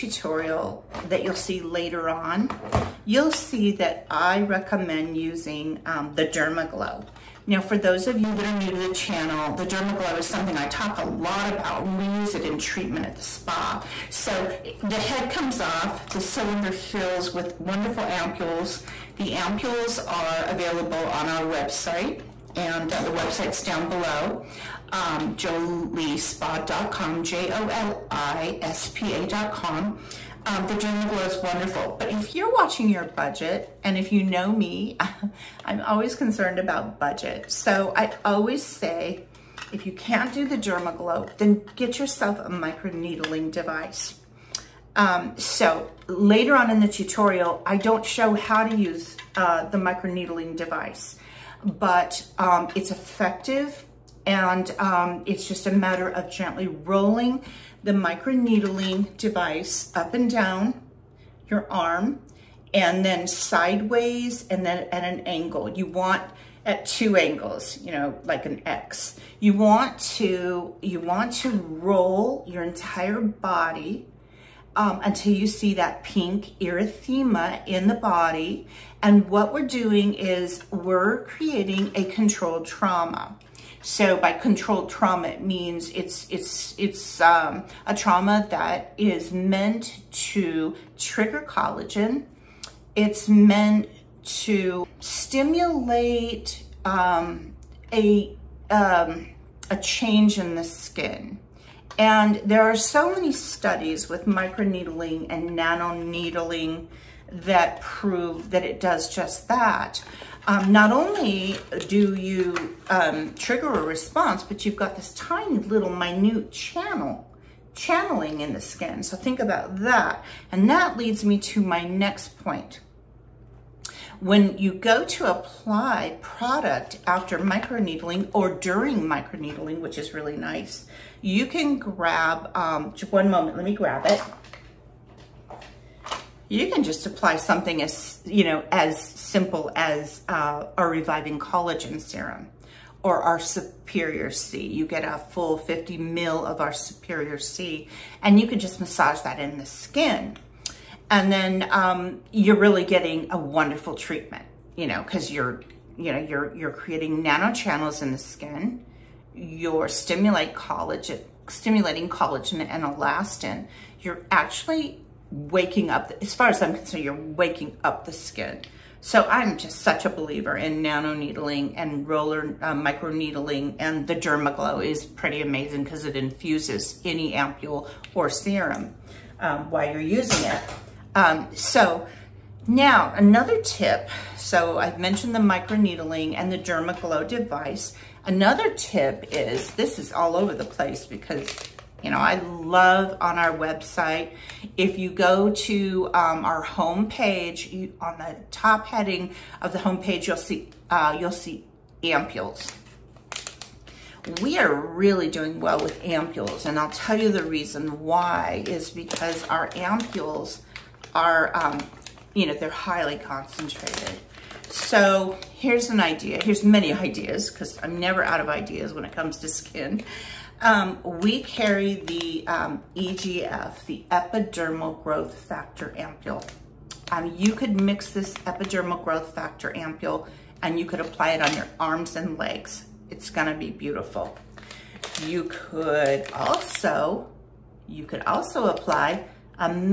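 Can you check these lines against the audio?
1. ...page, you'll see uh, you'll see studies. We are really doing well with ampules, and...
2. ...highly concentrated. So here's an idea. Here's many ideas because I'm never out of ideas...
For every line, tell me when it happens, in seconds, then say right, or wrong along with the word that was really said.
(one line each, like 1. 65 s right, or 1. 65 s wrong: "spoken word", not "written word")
1. 199 s wrong: "ampules", not "studies"
2. 212 s right.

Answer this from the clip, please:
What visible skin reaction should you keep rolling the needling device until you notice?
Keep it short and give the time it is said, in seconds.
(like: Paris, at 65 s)
pink erythema, at 76 s.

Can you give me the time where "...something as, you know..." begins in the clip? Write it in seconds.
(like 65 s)
137 s.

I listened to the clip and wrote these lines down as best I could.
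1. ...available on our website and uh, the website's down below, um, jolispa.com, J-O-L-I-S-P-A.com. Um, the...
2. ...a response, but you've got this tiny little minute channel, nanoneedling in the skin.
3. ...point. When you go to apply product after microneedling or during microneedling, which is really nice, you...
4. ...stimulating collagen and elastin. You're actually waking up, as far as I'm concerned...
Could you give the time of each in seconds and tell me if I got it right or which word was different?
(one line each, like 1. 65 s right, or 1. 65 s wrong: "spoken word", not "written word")
1. 20 s right
2. 113 s wrong: "channeling", not "nanoneedling"
3. 122 s right
4. 161 s right.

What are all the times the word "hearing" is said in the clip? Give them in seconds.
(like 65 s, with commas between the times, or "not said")
not said.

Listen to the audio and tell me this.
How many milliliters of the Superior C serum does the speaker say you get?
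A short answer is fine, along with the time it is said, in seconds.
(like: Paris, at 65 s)
50, at 145 s.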